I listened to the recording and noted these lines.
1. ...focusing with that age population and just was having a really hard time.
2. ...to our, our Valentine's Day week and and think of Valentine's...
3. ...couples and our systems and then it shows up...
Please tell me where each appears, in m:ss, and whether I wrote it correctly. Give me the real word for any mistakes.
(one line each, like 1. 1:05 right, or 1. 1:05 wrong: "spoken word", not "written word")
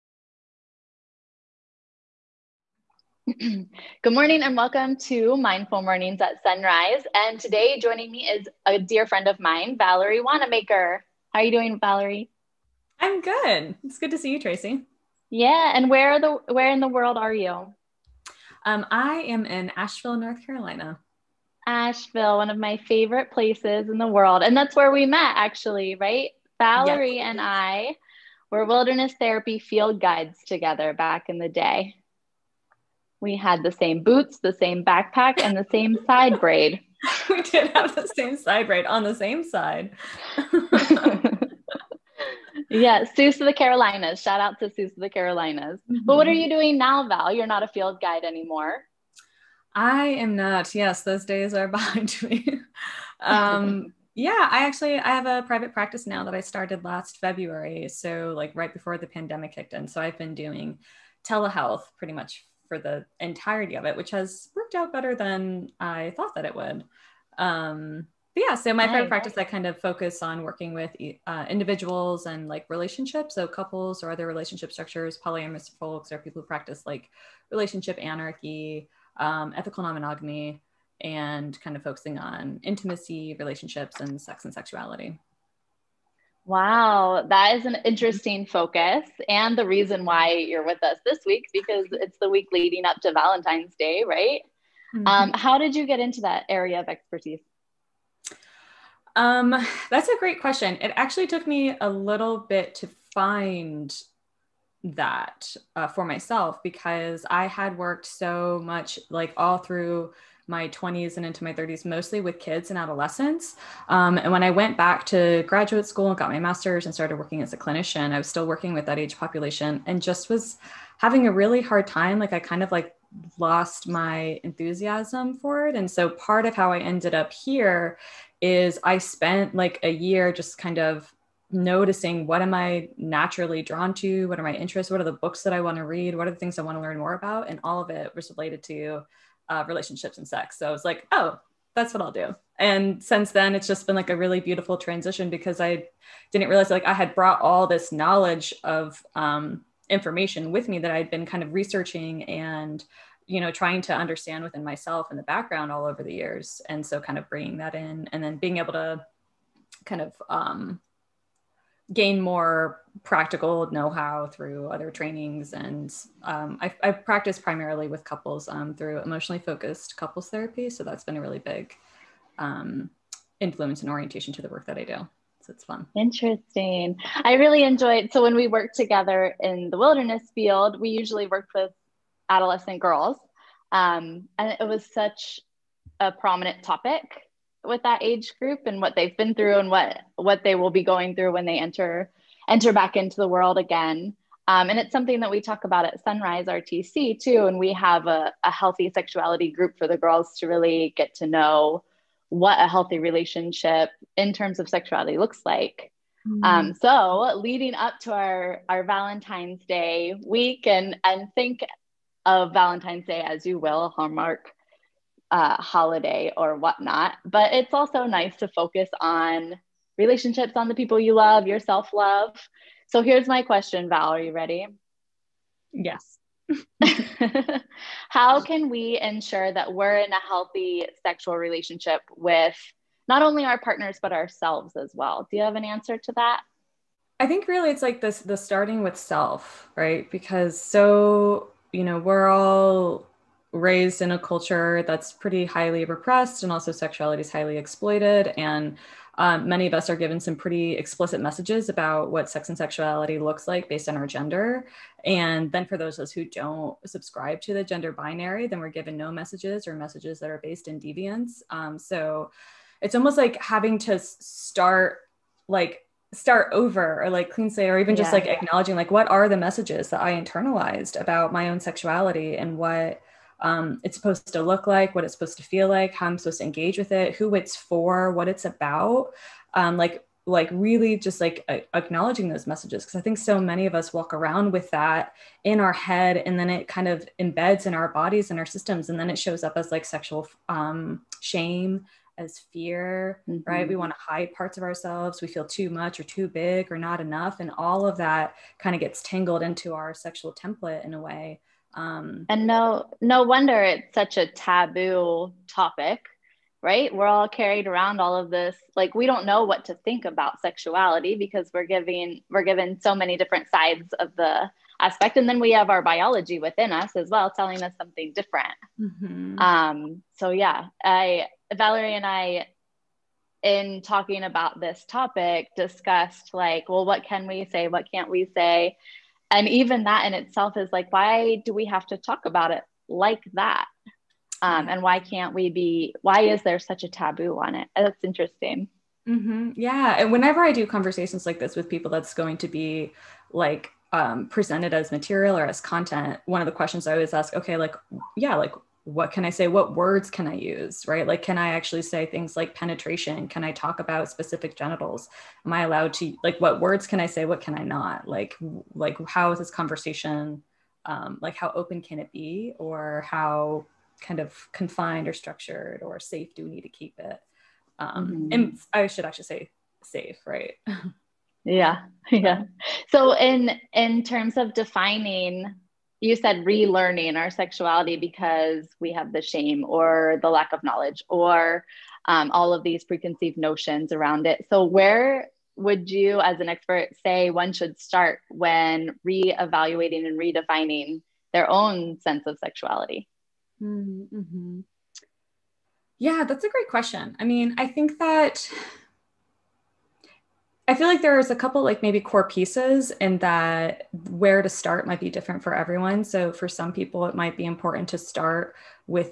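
1. 1:58 wrong: "working", not "focusing"
2. 3:27 right
3. 4:47 wrong: "bodies", not "couples".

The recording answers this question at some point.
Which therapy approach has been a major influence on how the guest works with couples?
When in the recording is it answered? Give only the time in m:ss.
2:49.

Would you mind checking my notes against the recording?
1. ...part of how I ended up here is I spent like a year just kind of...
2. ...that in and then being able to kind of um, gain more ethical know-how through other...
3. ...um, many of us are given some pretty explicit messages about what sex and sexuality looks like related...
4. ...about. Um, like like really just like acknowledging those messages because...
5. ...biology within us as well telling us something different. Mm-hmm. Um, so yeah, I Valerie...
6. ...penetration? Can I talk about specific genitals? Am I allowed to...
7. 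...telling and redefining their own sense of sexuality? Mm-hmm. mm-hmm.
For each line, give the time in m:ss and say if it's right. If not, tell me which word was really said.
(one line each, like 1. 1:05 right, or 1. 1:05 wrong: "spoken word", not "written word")
1. 2:06 right
2. 2:37 wrong: "practical", not "ethical"
3. 4:09 wrong: "based", not "related"
4. 4:38 right
5. 5:15 right
6. 5:52 right
7. 6:29 wrong: "reevaluating", not "telling".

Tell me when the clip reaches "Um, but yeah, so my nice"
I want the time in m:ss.
1:07.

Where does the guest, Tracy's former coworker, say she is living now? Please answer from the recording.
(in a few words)
Asheville, North Carolina.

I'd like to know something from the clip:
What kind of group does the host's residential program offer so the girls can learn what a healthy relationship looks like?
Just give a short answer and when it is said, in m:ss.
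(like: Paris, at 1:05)
Healthy sexuality group, at 3:18.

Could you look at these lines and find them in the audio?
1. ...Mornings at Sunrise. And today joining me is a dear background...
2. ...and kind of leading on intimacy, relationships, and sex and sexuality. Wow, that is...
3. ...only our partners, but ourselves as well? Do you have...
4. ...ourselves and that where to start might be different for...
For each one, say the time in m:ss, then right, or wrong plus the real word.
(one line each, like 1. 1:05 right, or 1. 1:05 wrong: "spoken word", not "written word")
1. 0:05 wrong: "friend", not "background"
2. 1:20 wrong: "focusing", not "leading"
3. 3:53 right
4. 6:42 wrong: "pieces", not "ourselves".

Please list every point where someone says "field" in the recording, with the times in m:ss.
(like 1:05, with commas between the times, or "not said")
0:29, 0:47, 3:00.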